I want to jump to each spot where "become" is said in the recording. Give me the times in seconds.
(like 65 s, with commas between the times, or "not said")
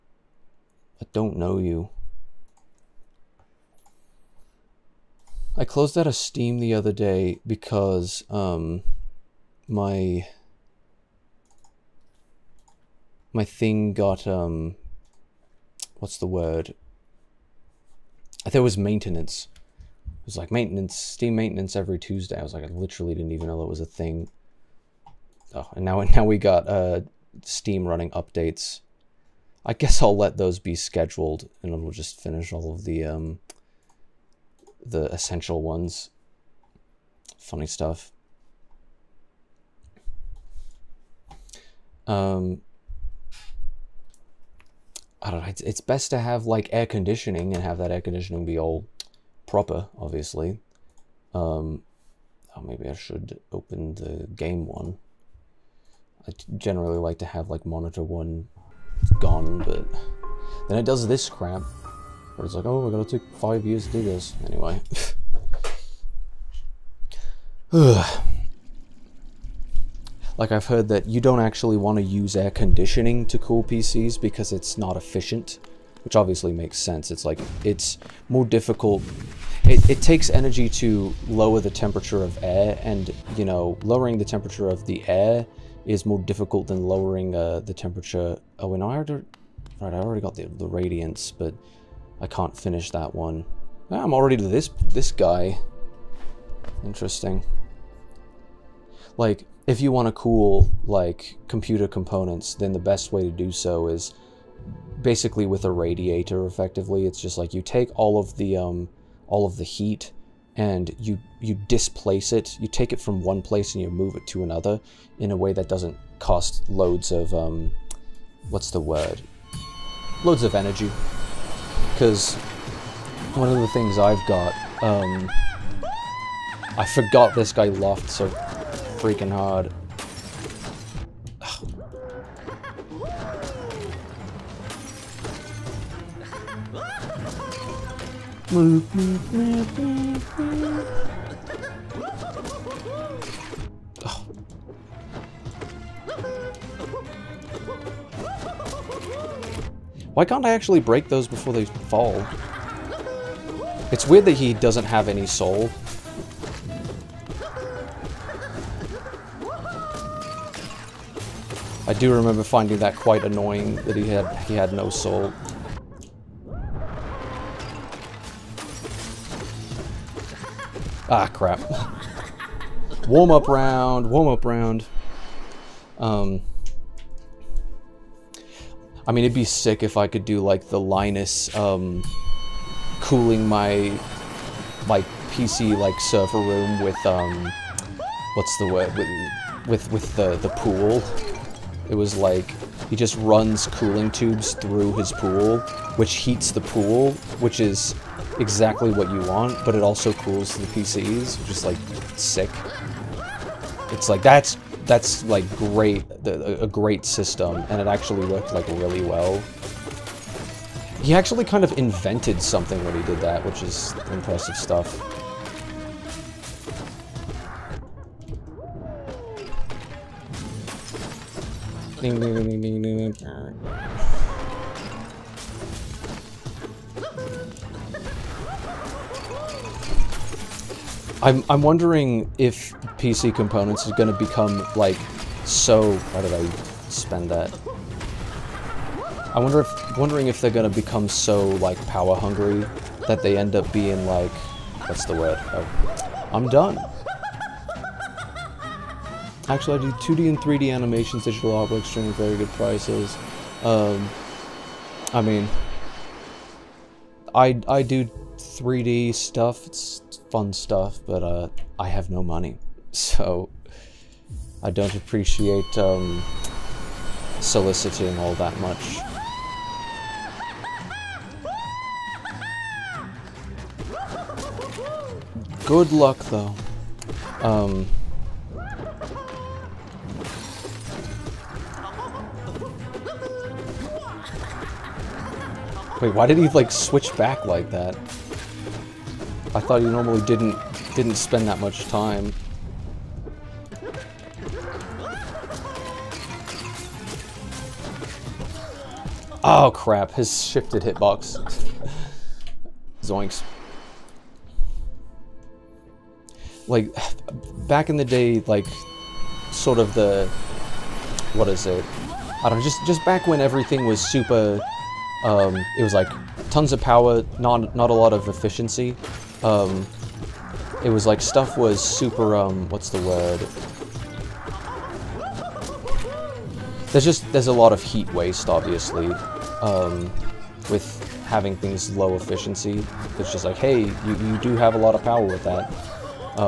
234 s, 240 s.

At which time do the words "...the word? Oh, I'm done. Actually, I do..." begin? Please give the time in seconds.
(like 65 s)
245 s.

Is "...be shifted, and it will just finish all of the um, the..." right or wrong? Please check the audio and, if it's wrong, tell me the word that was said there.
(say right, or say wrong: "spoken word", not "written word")
wrong: "scheduled", not "shifted".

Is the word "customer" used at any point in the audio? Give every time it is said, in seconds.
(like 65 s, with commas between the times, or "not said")
not said.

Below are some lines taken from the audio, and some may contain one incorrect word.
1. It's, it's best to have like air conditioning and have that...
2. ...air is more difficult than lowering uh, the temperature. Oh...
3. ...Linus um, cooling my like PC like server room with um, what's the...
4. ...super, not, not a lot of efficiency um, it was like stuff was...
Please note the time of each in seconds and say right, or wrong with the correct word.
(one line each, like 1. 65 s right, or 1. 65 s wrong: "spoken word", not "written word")
1. 45 s right
2. 85 s right
3. 180 s right
4. 316 s wrong: "power", not "super".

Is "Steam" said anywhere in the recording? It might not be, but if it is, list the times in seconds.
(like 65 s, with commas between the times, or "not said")
6 s, 20 s, 27 s.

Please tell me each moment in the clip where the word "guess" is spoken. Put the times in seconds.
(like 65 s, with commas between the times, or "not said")
29 s.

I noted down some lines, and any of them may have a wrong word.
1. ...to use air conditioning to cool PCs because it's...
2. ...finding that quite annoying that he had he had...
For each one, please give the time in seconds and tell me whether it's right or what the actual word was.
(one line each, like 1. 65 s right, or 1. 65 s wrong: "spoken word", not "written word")
1. 71 s right
2. 162 s right.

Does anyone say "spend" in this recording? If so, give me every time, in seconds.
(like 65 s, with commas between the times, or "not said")
236 s, 291 s.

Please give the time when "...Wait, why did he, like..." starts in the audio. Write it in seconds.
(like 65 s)
286 s.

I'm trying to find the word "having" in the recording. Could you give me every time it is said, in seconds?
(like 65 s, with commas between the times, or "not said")
331 s.